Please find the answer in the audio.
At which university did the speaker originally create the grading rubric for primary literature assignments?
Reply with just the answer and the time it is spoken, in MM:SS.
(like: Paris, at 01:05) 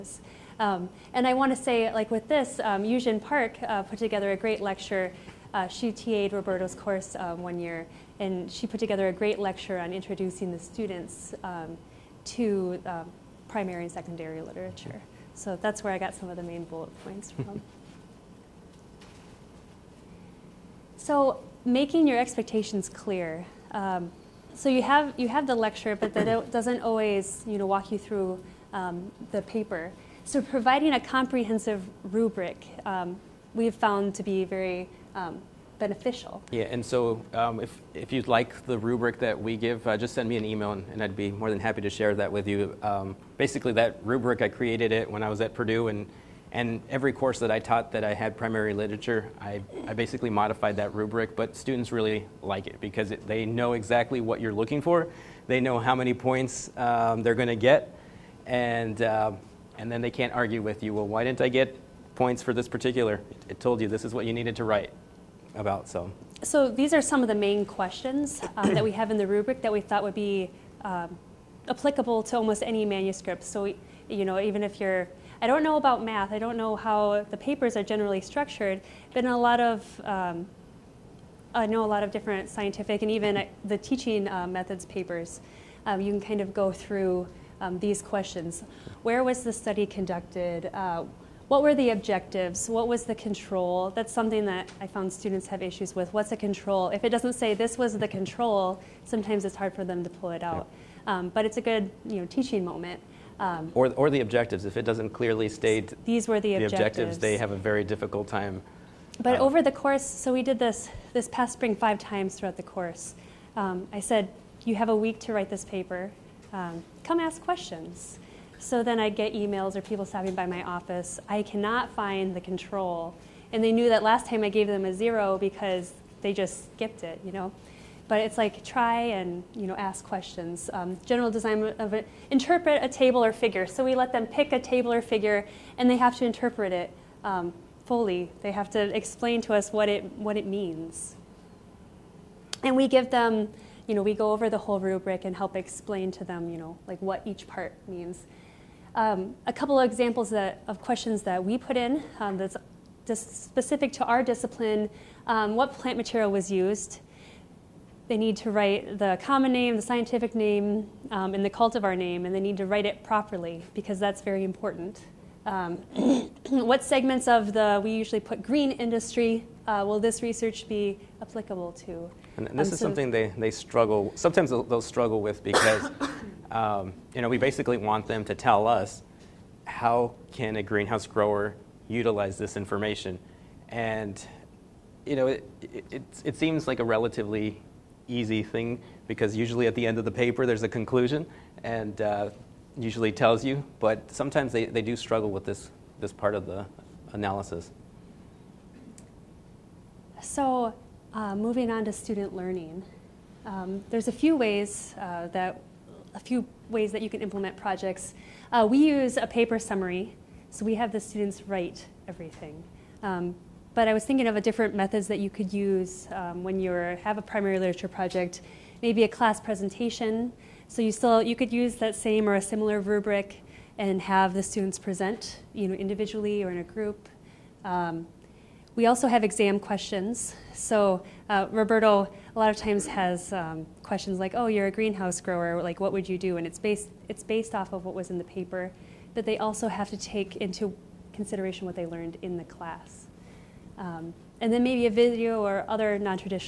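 Purdue, at 00:45.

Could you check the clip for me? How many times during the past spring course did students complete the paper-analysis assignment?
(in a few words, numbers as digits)
5.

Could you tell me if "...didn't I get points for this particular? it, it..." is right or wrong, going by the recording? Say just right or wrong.
right.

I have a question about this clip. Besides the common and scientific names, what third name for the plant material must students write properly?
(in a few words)
cultivar name.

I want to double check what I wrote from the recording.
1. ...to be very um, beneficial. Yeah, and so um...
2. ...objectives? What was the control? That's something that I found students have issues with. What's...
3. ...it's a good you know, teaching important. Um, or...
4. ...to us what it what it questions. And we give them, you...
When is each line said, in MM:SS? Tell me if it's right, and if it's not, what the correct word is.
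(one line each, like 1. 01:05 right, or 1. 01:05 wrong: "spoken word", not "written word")
1. 00:34 right
2. 01:31 right
3. 01:41 wrong: "moment", not "important"
4. 02:19 wrong: "means", not "questions".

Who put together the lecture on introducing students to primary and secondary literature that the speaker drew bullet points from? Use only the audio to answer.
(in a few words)
Eugene Park.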